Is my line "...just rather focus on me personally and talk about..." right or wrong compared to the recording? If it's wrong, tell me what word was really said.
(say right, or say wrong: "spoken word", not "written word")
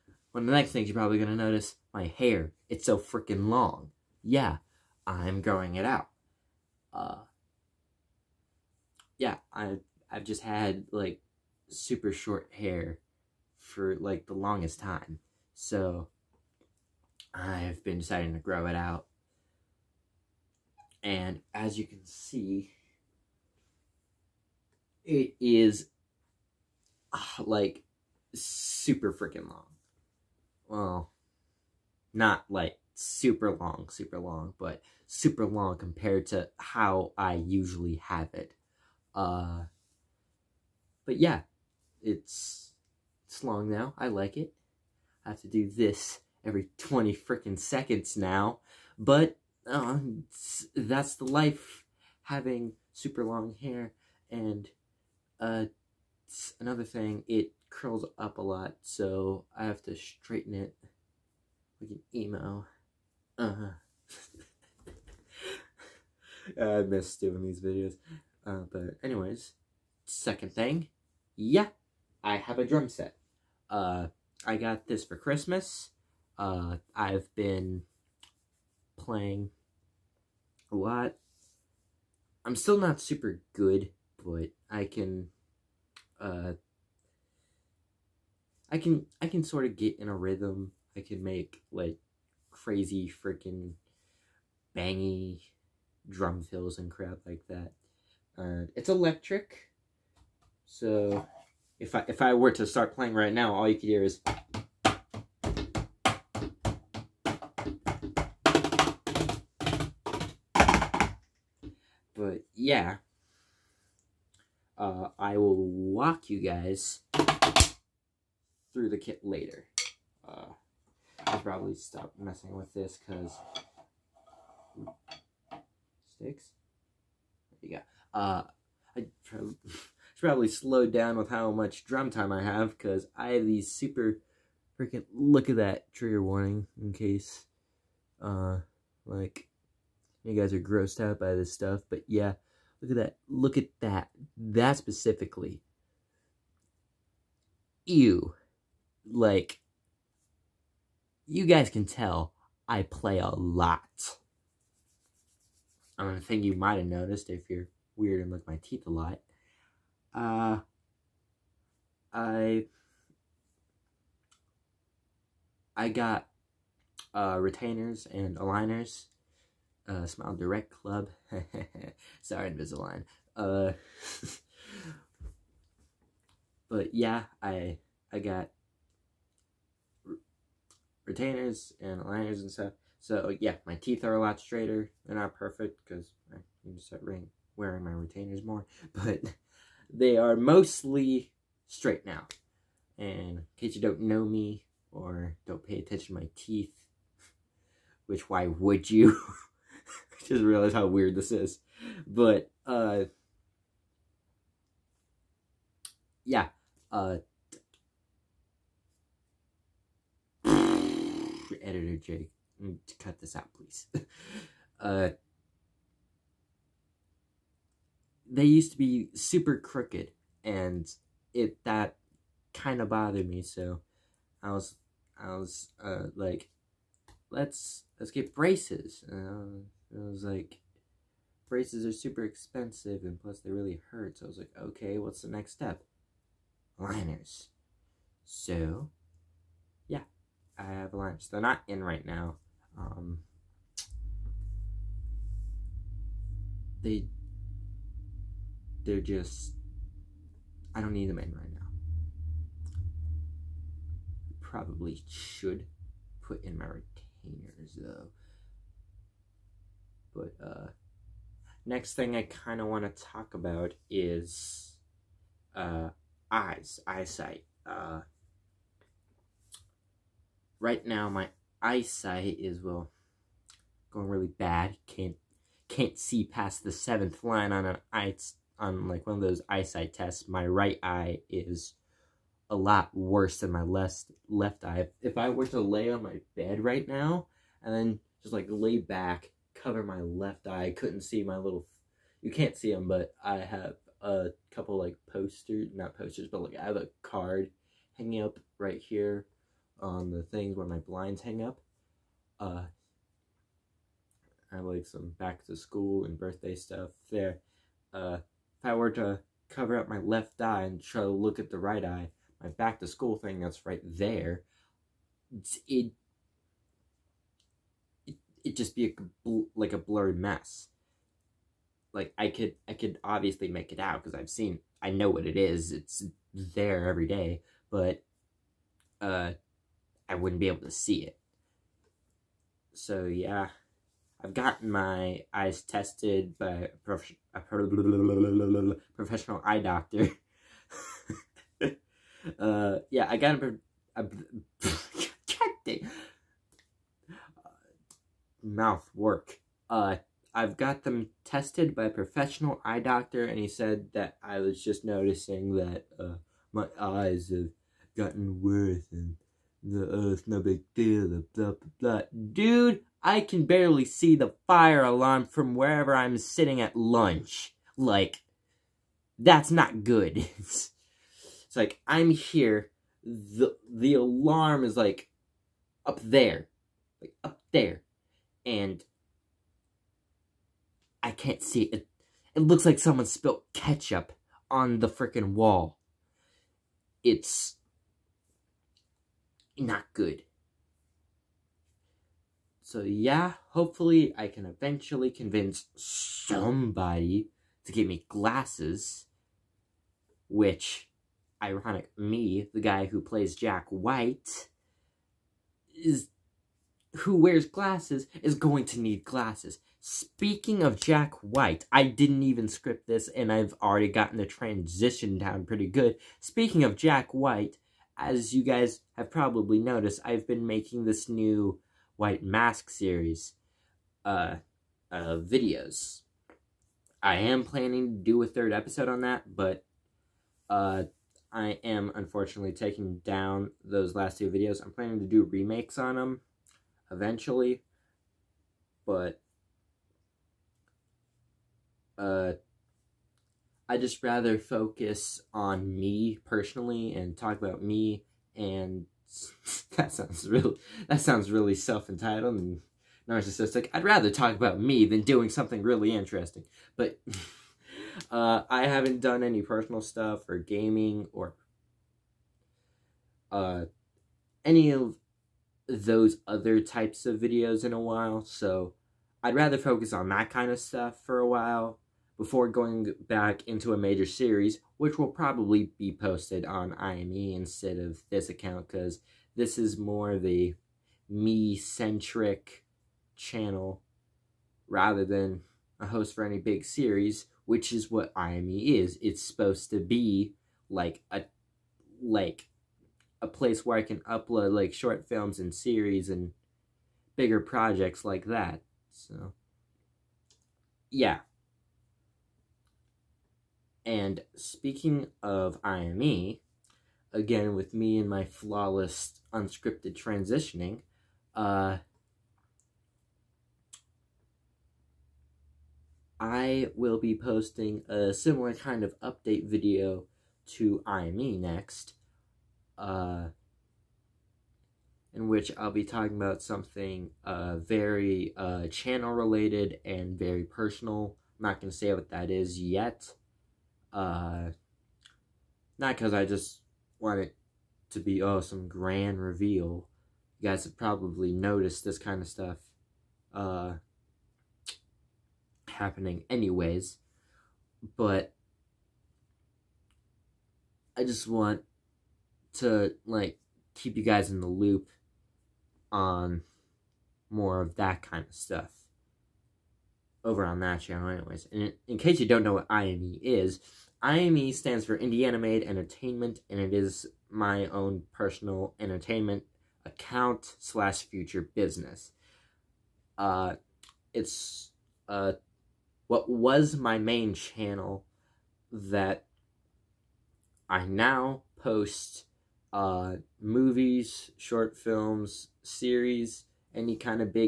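right.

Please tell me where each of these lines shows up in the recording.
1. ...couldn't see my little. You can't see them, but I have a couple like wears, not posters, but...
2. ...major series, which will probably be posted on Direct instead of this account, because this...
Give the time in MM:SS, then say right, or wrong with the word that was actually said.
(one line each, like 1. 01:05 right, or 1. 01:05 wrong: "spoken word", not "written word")
1. 04:50 wrong: "posters", not "wears"
2. 07:53 wrong: "IME", not "Direct".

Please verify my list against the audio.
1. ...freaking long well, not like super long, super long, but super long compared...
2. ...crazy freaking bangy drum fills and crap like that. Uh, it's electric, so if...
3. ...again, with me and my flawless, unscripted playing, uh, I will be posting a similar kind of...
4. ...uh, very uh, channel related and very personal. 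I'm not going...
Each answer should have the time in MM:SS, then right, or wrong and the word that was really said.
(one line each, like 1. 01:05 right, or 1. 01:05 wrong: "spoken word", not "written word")
1. 00:29 right
2. 01:32 right
3. 08:27 wrong: "transitioning", not "playing"
4. 08:47 right.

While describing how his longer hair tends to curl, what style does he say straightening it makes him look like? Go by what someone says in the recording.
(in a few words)
emo.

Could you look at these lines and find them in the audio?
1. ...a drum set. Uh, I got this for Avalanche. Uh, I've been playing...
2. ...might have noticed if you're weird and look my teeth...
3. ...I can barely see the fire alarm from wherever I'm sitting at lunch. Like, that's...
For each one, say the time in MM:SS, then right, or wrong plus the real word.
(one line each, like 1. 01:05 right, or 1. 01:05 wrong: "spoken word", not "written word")
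1. 01:12 wrong: "Christmas", not "Avalanche"
2. 02:36 right
3. 06:03 right.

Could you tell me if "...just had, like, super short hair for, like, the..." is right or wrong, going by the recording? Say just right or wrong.
right.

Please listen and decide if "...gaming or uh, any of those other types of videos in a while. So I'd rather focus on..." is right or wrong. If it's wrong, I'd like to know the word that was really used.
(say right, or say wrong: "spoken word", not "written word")
right.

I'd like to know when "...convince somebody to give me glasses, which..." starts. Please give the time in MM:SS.
06:35.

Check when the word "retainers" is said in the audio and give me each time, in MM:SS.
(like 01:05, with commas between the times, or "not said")
02:47, 03:01, 03:07, 04:16.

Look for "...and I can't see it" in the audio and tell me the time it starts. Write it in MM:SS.
06:18.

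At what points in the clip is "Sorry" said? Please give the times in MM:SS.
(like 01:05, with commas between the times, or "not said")
02:52.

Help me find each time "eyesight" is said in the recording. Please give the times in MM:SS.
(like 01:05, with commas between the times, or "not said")
04:26, 04:31, 04:39.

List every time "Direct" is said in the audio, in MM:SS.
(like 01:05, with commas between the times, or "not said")
02:50.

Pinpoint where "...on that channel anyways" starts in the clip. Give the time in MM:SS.
09:20.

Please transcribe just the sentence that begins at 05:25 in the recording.
It's there every day, but uh I wouldn't be able to see it.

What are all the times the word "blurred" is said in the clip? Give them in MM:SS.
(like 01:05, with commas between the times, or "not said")
05:19.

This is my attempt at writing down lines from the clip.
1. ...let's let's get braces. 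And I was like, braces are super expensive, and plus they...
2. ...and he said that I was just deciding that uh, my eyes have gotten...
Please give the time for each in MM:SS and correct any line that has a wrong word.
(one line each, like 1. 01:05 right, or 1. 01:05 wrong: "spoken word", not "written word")
1. 03:47 right
2. 05:53 wrong: "noticing", not "deciding".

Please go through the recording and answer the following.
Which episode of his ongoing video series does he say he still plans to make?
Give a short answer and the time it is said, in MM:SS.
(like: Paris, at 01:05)
third, at 07:08.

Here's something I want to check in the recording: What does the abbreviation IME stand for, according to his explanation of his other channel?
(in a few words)
Indiana Made Entertainment.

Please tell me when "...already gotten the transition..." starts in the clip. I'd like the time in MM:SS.
06:53.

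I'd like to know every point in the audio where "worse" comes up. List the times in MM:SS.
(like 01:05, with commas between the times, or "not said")
04:42, 05:58.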